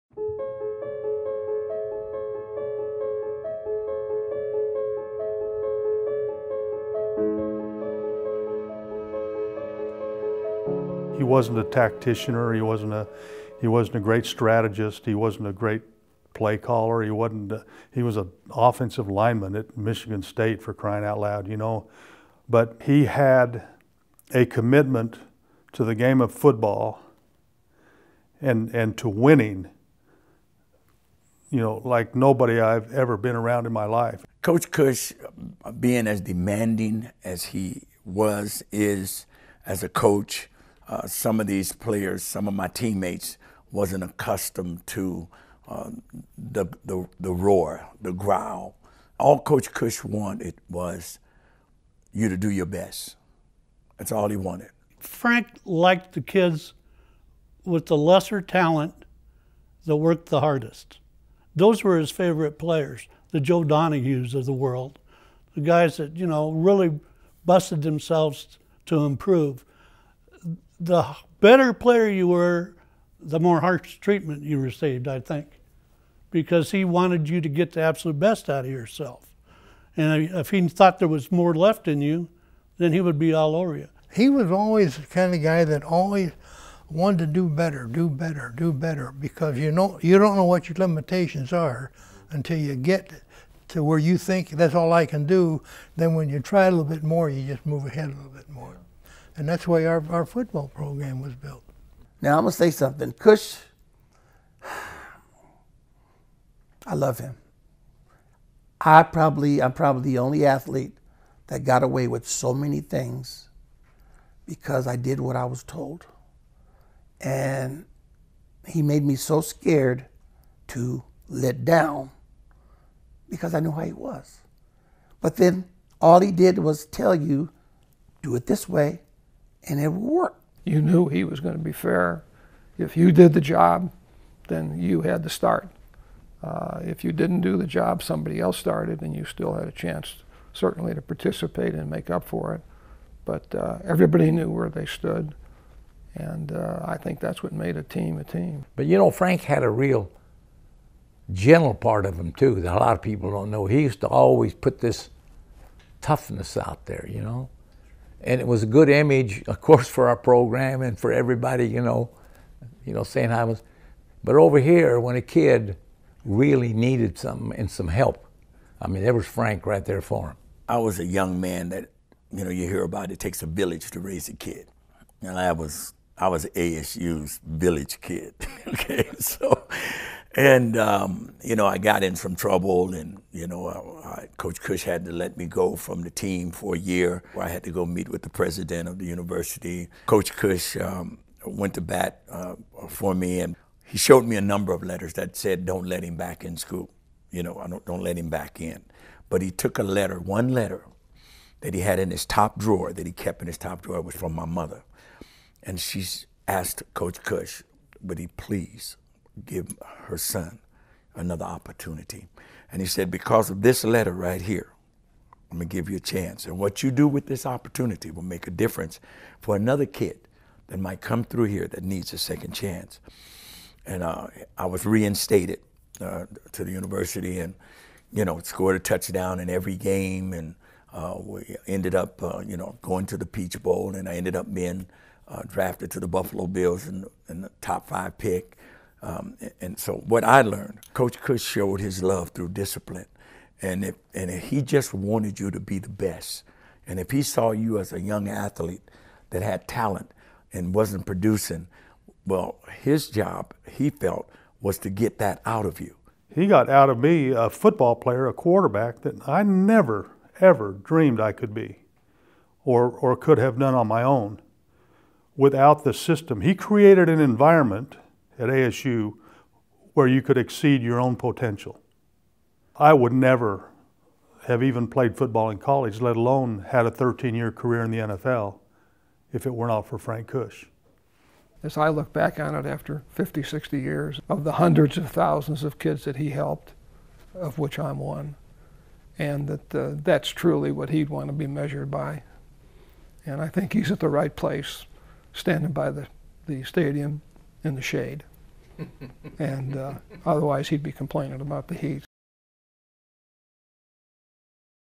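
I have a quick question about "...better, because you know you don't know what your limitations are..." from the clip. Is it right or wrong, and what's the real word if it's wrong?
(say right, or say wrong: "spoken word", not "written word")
right.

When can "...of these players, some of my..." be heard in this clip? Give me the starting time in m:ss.
0:41.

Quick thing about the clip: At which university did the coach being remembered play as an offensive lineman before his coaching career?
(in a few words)
Michigan State.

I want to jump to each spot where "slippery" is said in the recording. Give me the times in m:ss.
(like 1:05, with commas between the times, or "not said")
not said.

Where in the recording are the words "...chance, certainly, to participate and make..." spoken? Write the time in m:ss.
2:19.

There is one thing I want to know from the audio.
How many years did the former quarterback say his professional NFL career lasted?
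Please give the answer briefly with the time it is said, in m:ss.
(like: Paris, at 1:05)
13, at 4:36.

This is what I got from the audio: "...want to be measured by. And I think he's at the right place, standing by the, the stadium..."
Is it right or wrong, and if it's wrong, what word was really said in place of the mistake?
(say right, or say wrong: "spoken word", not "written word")
right.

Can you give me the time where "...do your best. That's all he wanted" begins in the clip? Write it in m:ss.
0:52.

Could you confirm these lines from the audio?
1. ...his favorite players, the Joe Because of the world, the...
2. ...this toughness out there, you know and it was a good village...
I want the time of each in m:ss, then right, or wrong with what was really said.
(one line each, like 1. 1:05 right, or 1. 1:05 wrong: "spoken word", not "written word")
1. 1:01 wrong: "Donahues", not "Because"
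2. 2:34 wrong: "image", not "village".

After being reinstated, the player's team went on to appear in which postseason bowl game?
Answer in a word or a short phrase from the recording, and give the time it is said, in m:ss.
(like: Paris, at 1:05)
Peach Bowl, at 3:53.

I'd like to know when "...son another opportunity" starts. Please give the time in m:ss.
3:30.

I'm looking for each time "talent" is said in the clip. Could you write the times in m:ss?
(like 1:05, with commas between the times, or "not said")
0:58, 4:09.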